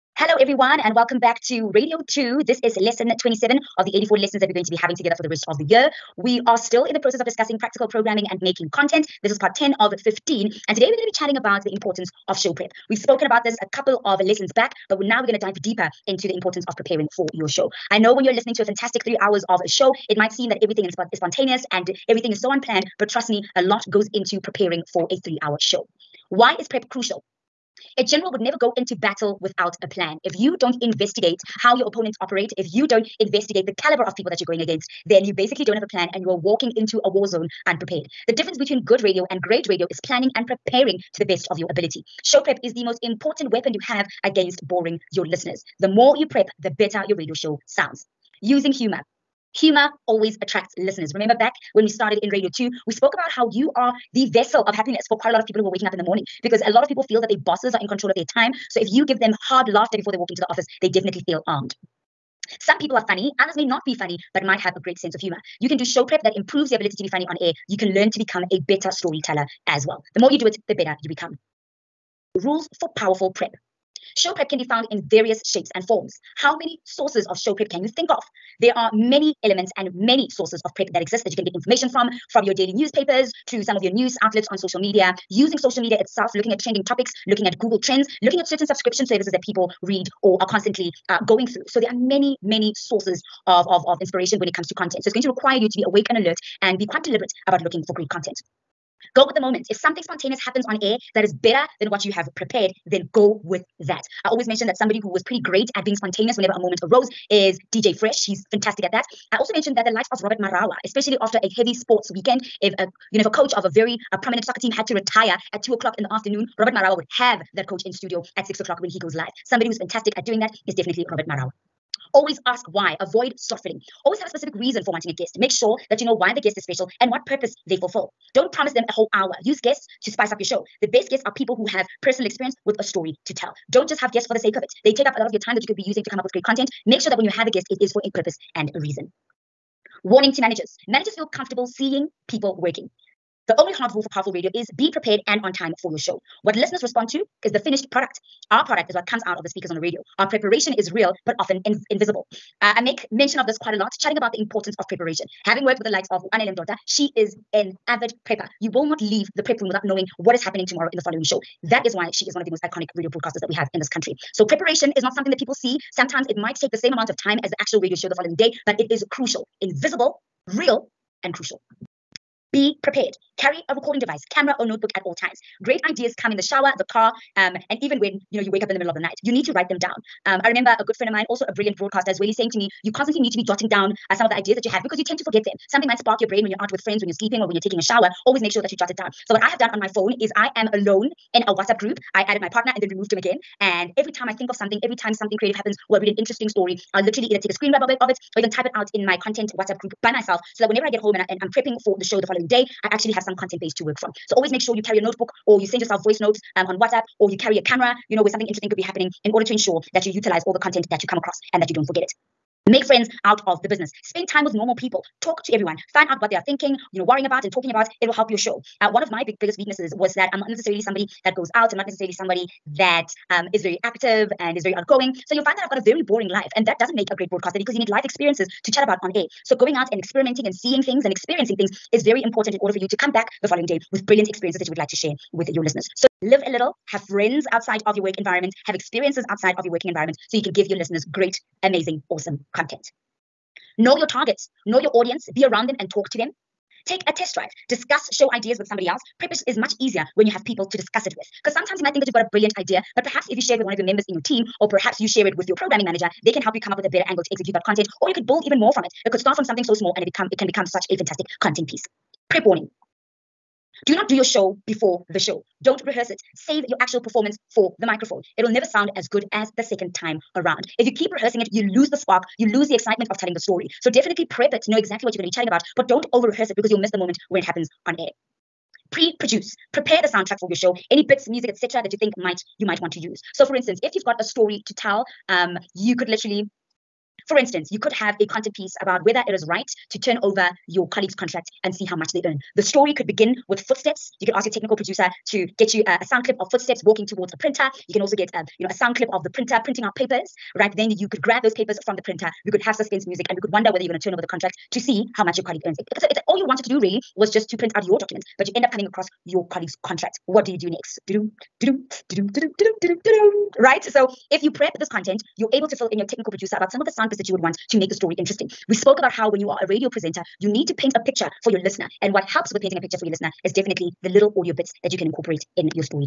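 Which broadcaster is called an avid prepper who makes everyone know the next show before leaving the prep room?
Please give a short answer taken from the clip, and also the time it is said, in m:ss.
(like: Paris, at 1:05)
Anele Mdoda, at 2:36.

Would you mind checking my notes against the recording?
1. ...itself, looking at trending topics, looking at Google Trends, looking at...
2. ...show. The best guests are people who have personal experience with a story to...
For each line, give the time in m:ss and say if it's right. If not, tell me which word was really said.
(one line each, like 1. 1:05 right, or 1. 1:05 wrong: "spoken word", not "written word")
1. 1:25 right
2. 2:10 right.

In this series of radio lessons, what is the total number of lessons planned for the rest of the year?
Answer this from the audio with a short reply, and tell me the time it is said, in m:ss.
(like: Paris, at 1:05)
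84, at 0:03.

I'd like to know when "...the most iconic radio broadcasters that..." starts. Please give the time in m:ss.
2:42.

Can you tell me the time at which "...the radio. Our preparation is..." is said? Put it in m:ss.
2:29.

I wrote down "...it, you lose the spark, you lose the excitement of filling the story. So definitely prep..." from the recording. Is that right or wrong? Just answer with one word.
wrong.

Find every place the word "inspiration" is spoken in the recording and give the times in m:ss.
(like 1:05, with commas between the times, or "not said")
1:34.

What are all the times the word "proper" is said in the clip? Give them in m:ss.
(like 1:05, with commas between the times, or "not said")
not said.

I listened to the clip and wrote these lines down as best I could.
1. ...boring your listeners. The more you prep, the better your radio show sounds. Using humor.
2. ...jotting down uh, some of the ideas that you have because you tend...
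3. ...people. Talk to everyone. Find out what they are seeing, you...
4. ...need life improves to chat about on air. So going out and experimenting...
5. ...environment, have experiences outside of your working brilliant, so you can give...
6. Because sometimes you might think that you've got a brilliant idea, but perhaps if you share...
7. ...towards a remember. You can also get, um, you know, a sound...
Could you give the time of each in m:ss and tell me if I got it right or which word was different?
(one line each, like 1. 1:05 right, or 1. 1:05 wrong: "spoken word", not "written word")
1. 0:44 right
2. 3:03 right
3. 3:34 wrong: "thinking", not "seeing"
4. 3:47 wrong: "experiences", not "improves"
5. 3:58 wrong: "environment", not "brilliant"
6. 4:11 right
7. 4:57 wrong: "printer", not "remember".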